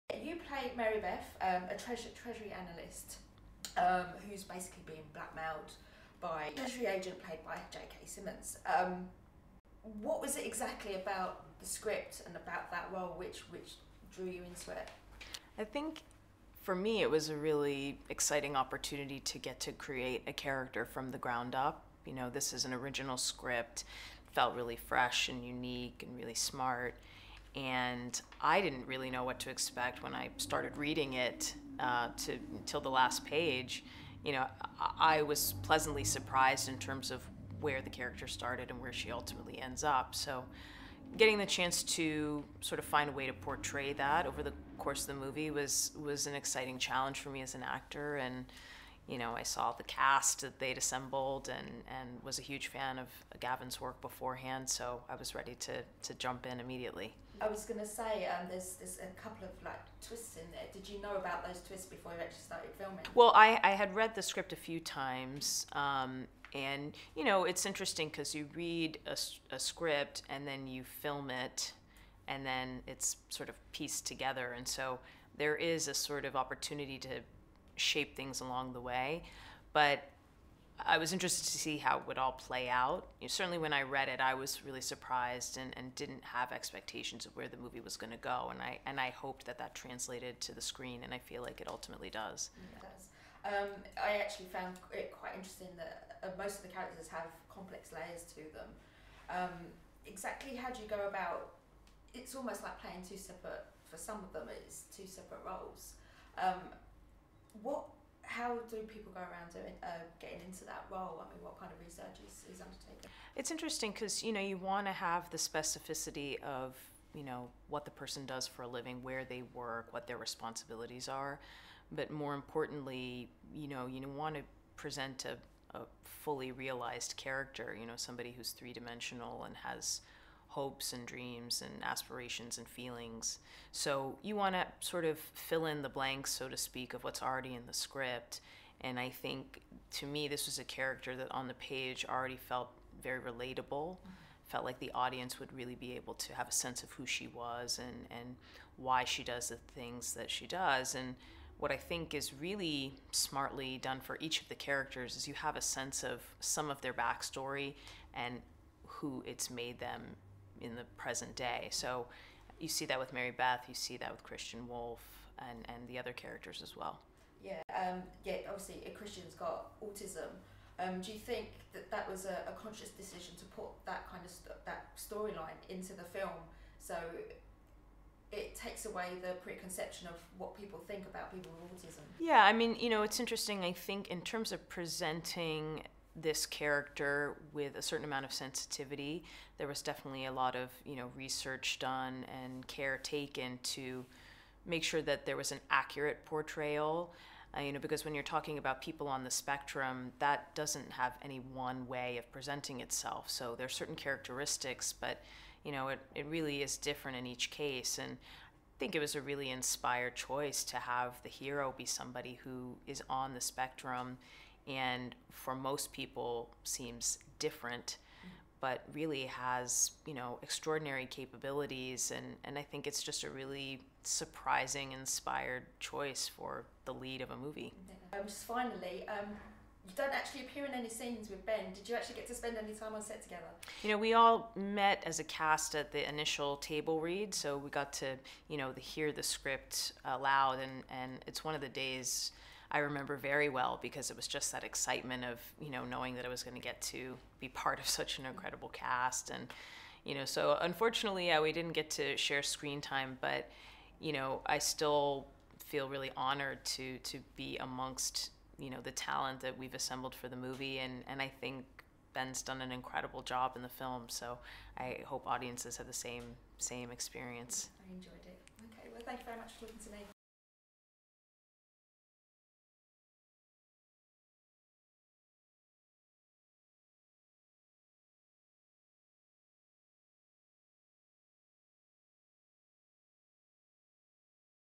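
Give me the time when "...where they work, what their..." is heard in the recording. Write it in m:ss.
1:59.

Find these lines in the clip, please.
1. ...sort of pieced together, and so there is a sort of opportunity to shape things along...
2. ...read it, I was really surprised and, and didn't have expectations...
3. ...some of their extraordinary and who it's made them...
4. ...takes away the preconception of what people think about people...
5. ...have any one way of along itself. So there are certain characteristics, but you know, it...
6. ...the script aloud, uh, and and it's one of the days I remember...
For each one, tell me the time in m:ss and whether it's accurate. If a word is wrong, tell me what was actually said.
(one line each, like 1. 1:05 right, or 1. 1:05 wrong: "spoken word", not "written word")
1. 1:13 right
2. 1:23 right
3. 2:36 wrong: "backstory", not "extraordinary"
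4. 2:58 right
5. 3:20 wrong: "presenting", not "along"
6. 3:59 right.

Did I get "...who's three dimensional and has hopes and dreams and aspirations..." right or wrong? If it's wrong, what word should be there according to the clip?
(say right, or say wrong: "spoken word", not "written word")
right.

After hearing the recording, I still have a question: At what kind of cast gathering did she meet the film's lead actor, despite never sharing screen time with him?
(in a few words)
Initial table read.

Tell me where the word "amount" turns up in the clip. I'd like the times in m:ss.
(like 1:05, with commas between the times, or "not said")
3:08.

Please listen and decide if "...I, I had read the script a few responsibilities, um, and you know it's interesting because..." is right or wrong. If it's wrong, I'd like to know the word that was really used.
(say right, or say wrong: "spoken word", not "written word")
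wrong: "times", not "responsibilities".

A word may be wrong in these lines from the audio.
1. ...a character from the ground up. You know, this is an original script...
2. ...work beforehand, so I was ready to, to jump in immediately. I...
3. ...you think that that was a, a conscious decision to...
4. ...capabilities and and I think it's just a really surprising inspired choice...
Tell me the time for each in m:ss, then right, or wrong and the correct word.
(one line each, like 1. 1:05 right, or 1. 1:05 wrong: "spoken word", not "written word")
1. 0:20 right
2. 0:53 right
3. 2:51 right
4. 3:41 right.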